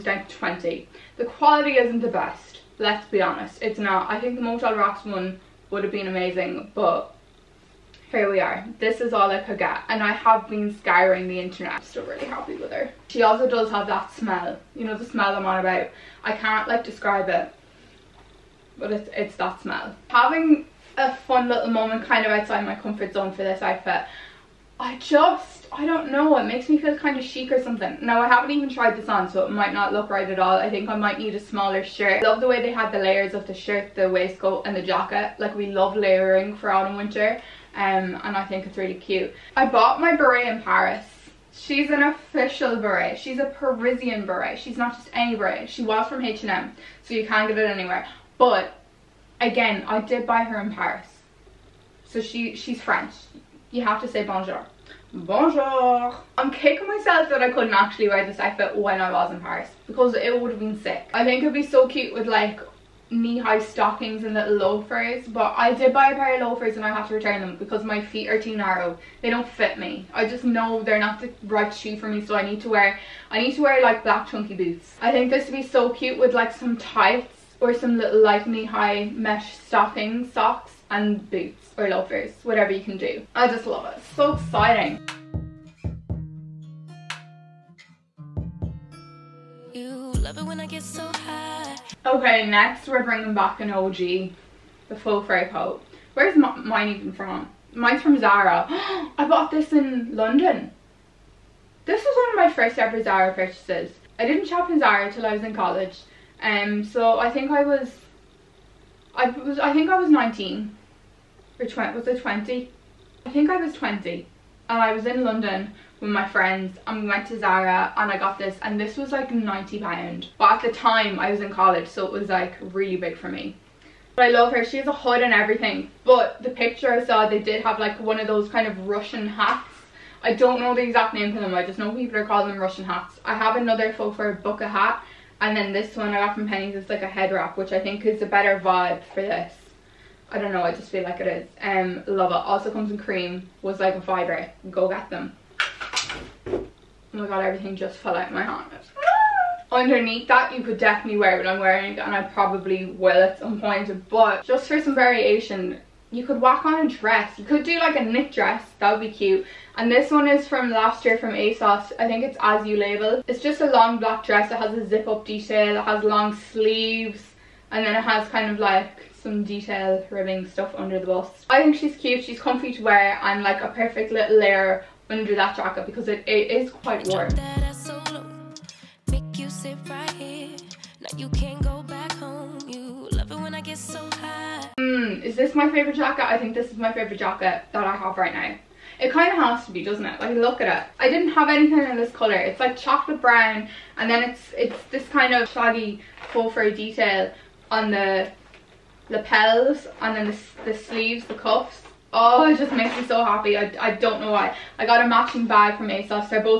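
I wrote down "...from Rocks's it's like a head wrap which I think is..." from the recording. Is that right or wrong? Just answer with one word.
wrong.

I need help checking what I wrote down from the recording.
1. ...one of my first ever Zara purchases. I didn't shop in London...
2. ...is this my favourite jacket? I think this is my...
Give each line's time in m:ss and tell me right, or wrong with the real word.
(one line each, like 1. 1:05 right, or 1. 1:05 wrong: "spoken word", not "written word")
1. 1:42 wrong: "Zara", not "London"
2. 3:05 right.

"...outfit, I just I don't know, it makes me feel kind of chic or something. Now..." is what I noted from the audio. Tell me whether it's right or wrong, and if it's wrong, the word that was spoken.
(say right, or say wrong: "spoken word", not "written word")
right.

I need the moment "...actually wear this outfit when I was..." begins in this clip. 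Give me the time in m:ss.
0:57.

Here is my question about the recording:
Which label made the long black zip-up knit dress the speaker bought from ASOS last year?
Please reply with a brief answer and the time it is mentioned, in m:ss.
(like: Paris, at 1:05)
As You Label, at 2:42.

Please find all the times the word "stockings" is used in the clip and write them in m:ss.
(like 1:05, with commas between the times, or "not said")
1:03, 1:19.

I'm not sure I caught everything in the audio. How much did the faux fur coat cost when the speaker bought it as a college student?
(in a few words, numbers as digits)
90 pounds.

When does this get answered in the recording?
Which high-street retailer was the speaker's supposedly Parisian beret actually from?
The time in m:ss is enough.
0:46.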